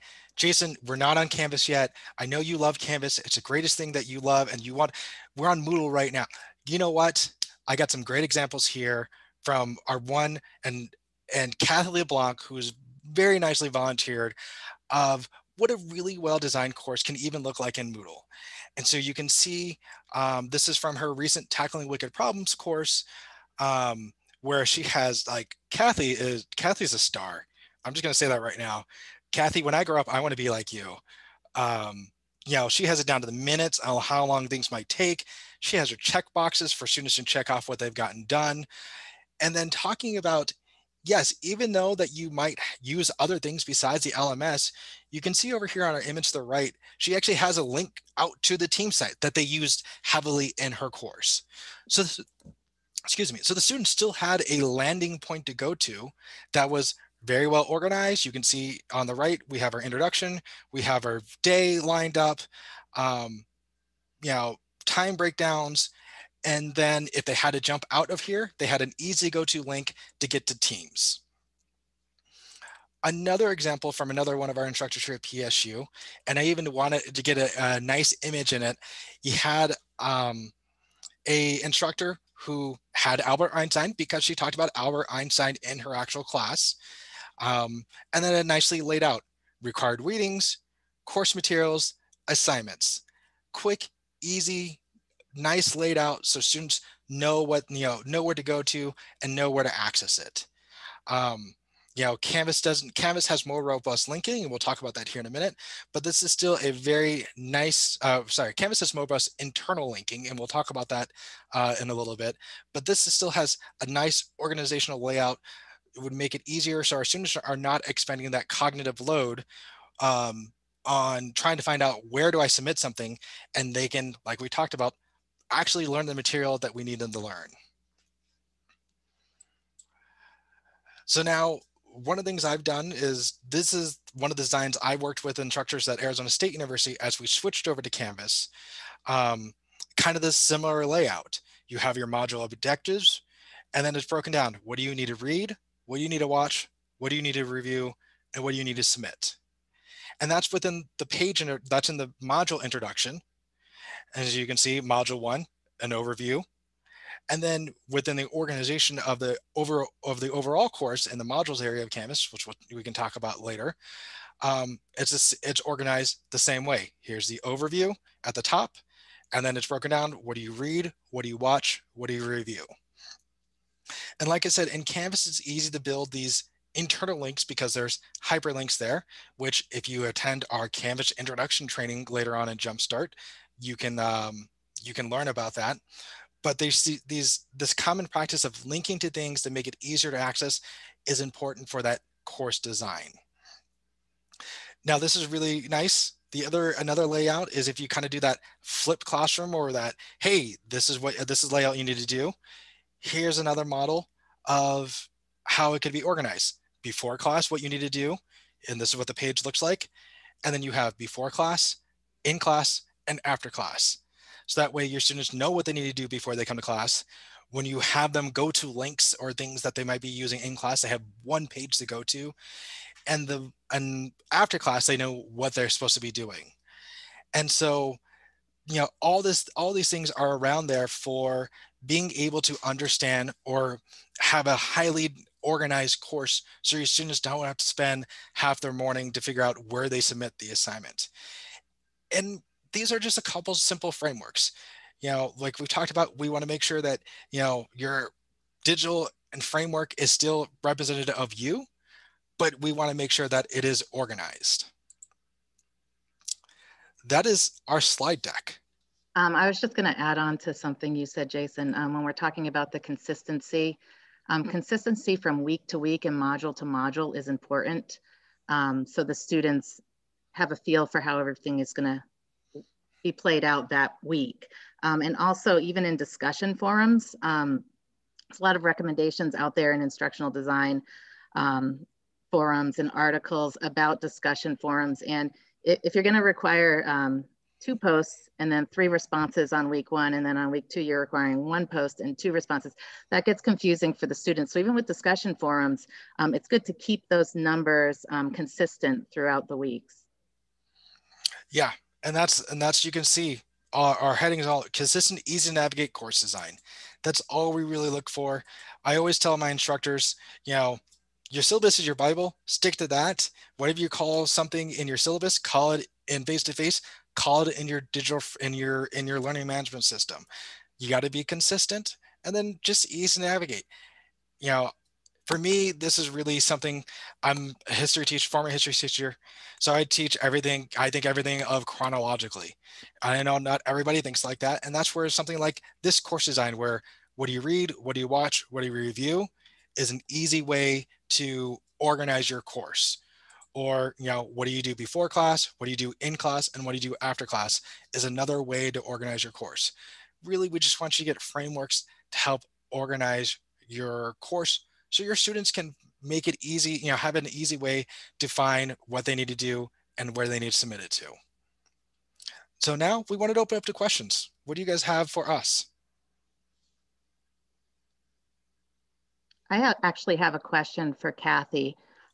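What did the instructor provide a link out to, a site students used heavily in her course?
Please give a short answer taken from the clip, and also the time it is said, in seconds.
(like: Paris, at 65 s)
Teams, at 48 s.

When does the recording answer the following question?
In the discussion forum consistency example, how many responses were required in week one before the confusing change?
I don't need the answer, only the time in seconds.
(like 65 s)
288 s.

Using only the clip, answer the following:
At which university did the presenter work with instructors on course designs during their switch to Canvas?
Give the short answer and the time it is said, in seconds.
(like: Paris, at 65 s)
Arizona State University, at 136 s.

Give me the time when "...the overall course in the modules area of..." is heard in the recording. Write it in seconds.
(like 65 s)
160 s.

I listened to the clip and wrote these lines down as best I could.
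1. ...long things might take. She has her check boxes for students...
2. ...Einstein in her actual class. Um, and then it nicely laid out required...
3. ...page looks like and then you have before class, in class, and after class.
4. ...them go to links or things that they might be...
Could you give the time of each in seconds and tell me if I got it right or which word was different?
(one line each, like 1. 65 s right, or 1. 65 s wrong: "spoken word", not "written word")
1. 34 s right
2. 85 s right
3. 209 s right
4. 218 s right.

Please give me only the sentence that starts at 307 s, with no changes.
That's all we really look for.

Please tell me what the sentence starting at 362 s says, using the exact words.
So now we wanted to open up to questions.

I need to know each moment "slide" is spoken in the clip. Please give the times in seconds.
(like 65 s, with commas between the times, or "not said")
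257 s.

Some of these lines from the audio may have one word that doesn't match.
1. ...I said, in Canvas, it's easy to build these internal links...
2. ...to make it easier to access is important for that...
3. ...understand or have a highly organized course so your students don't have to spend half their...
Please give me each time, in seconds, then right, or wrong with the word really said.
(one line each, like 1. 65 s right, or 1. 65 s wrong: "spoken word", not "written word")
1. 174 s right
2. 189 s right
3. 232 s right.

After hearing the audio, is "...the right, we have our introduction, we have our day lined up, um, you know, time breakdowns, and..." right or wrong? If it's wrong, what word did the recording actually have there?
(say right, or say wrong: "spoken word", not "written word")
right.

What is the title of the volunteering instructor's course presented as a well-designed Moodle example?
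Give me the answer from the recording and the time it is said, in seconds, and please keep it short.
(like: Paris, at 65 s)
Tackling Wicked Problems, at 21 s.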